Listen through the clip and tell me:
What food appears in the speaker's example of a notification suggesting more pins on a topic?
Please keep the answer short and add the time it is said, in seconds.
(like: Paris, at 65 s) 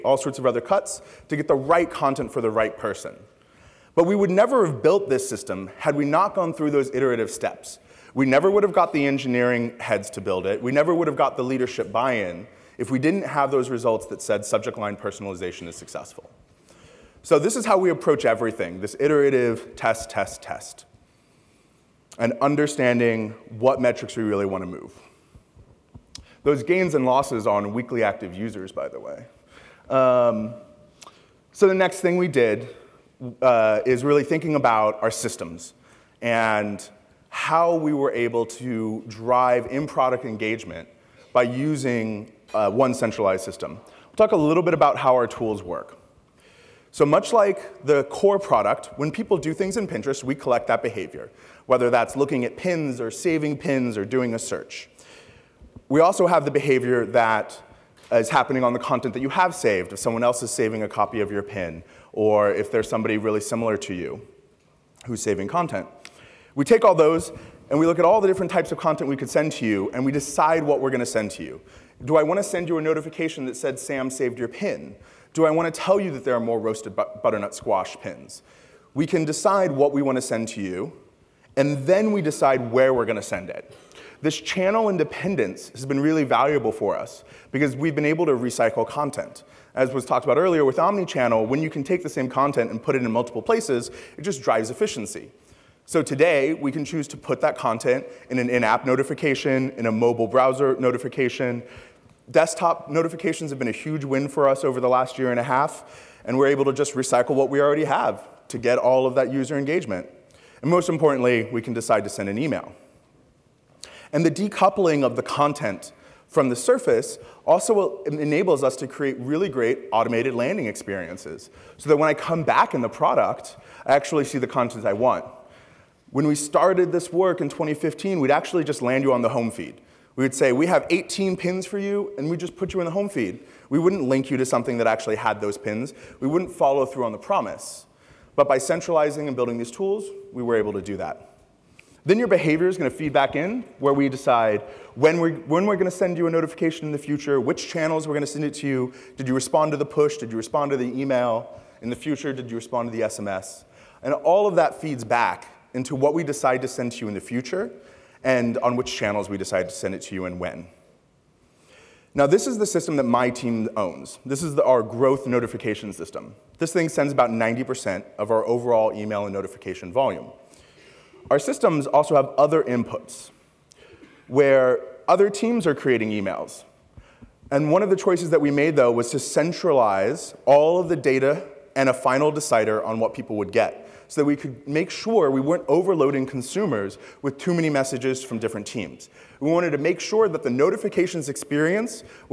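Roasted butternut squash, at 76 s.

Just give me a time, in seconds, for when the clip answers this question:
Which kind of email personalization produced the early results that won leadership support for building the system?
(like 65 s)
14 s.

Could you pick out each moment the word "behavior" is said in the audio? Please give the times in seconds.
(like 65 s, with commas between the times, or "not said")
50 s, 56 s, 142 s.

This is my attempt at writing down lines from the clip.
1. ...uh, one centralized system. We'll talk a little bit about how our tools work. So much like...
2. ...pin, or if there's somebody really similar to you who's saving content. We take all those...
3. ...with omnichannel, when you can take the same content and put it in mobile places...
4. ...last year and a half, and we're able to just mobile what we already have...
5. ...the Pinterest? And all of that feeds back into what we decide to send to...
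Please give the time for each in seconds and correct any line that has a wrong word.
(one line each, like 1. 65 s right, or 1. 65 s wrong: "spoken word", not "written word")
1. 42 s right
2. 61 s right
3. 90 s wrong: "multiple", not "mobile"
4. 104 s wrong: "recycle", not "mobile"
5. 152 s wrong: "SMS", not "Pinterest".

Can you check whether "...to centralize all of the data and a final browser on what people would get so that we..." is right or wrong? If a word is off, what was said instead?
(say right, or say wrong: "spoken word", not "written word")
wrong: "decider", not "browser".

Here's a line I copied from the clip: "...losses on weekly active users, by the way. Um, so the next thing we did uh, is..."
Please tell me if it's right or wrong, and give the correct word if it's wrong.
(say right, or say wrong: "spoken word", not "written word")
right.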